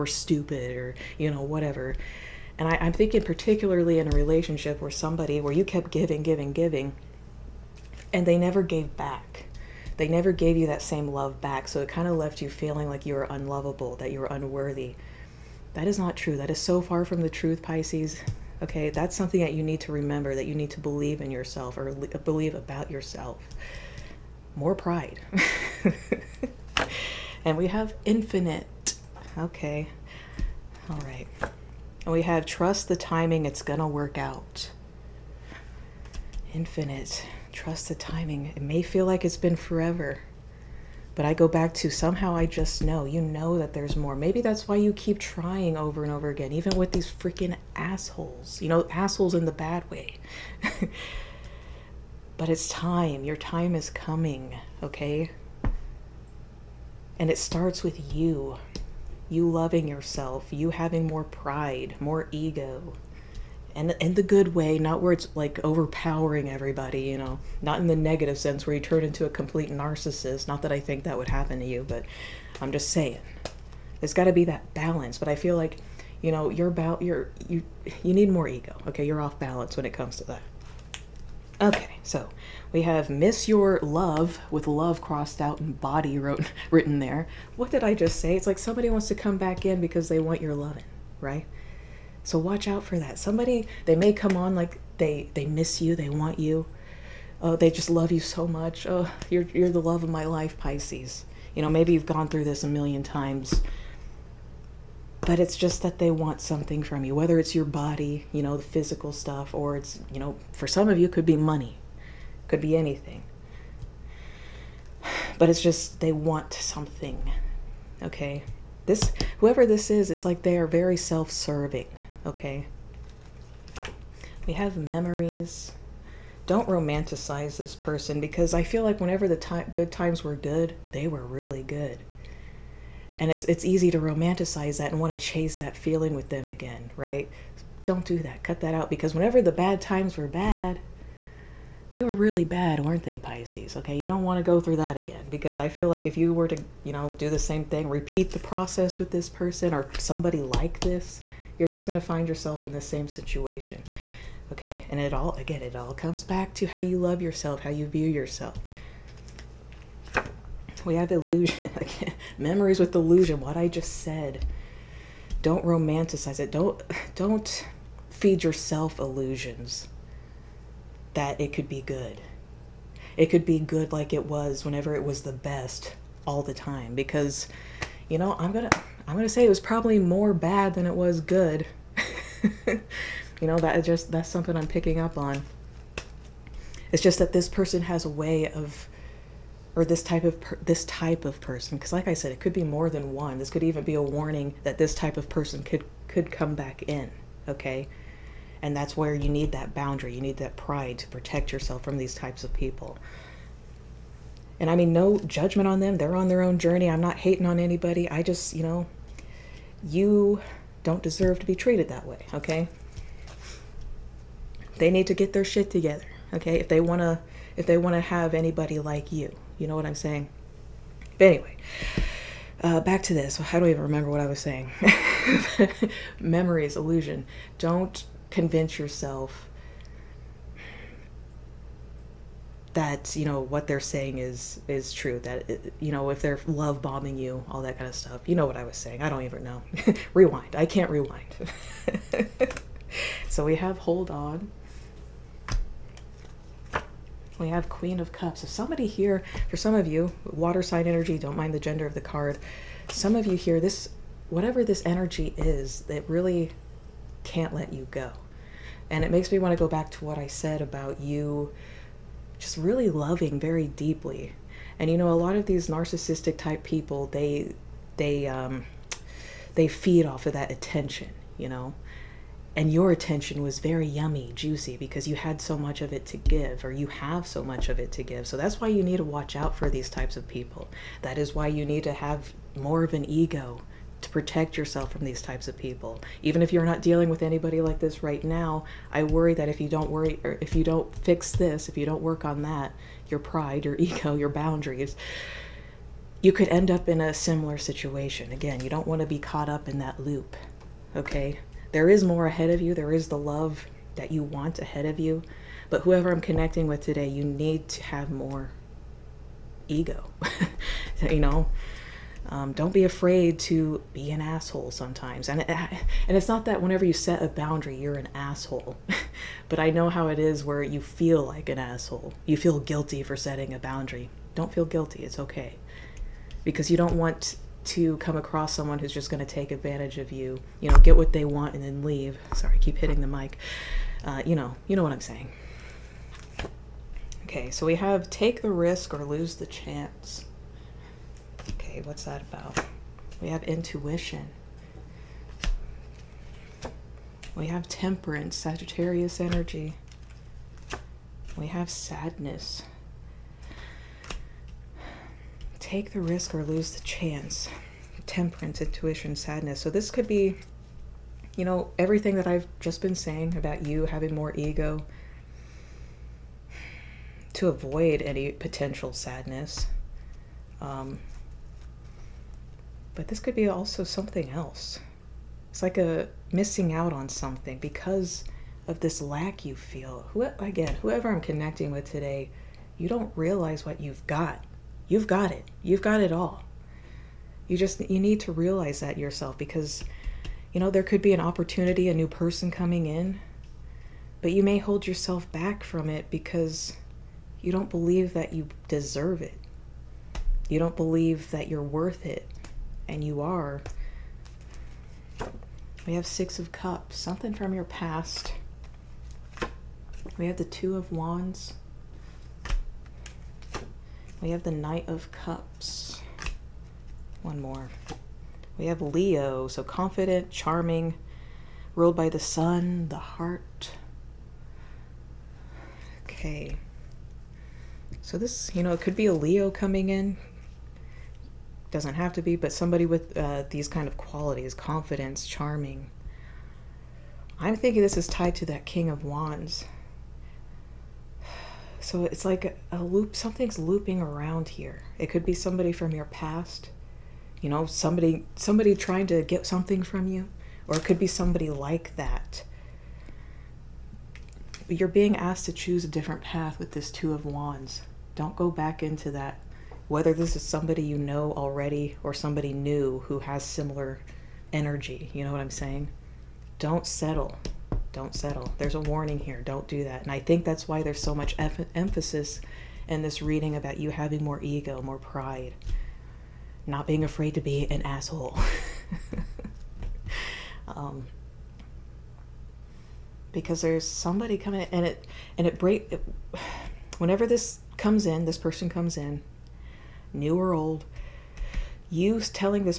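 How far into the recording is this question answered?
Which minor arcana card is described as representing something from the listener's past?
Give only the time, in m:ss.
6:46.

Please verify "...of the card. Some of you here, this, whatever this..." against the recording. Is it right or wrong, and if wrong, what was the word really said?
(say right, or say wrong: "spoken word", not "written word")
right.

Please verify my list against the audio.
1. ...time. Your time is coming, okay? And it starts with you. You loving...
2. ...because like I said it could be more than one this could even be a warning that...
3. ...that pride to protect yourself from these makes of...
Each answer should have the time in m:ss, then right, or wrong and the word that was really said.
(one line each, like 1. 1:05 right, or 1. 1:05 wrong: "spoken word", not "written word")
1. 0:52 right
2. 3:11 right
3. 3:20 wrong: "types", not "makes".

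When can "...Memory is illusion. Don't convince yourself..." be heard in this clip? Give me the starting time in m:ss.
3:46.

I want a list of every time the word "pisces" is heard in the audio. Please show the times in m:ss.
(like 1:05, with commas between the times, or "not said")
0:17, 1:40, 2:23.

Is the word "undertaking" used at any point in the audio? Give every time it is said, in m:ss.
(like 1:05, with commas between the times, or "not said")
not said.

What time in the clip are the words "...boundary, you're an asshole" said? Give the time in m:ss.
5:17.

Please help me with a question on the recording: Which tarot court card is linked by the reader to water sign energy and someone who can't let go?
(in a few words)
Queen of Cups.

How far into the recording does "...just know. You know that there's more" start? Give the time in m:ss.
0:42.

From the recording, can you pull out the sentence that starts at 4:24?
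And you know, a lot of these narcissistic type people, they, they, um, they feed off of that attention, you know?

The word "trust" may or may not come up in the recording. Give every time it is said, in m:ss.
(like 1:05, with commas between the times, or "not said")
0:32, 0:37.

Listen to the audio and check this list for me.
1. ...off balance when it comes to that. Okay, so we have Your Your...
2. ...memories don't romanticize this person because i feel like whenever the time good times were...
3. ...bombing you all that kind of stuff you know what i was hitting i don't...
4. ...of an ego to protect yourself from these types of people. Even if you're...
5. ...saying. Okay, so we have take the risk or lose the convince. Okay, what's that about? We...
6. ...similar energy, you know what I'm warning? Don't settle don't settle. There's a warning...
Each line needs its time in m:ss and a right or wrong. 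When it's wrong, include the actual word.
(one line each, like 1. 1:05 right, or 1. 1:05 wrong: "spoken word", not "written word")
1. 1:19 wrong: "Miss", not "Your"
2. 2:04 right
3. 3:56 wrong: "saying", not "hitting"
4. 4:42 right
5. 5:35 wrong: "chance", not "convince"
6. 7:43 wrong: "saying", not "warning".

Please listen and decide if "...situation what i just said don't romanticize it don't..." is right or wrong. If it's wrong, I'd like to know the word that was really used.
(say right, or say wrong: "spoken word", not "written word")
wrong: "illusion", not "situation".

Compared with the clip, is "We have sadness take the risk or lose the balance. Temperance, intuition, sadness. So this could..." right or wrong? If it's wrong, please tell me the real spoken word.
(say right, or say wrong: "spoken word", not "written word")
wrong: "chance", not "balance".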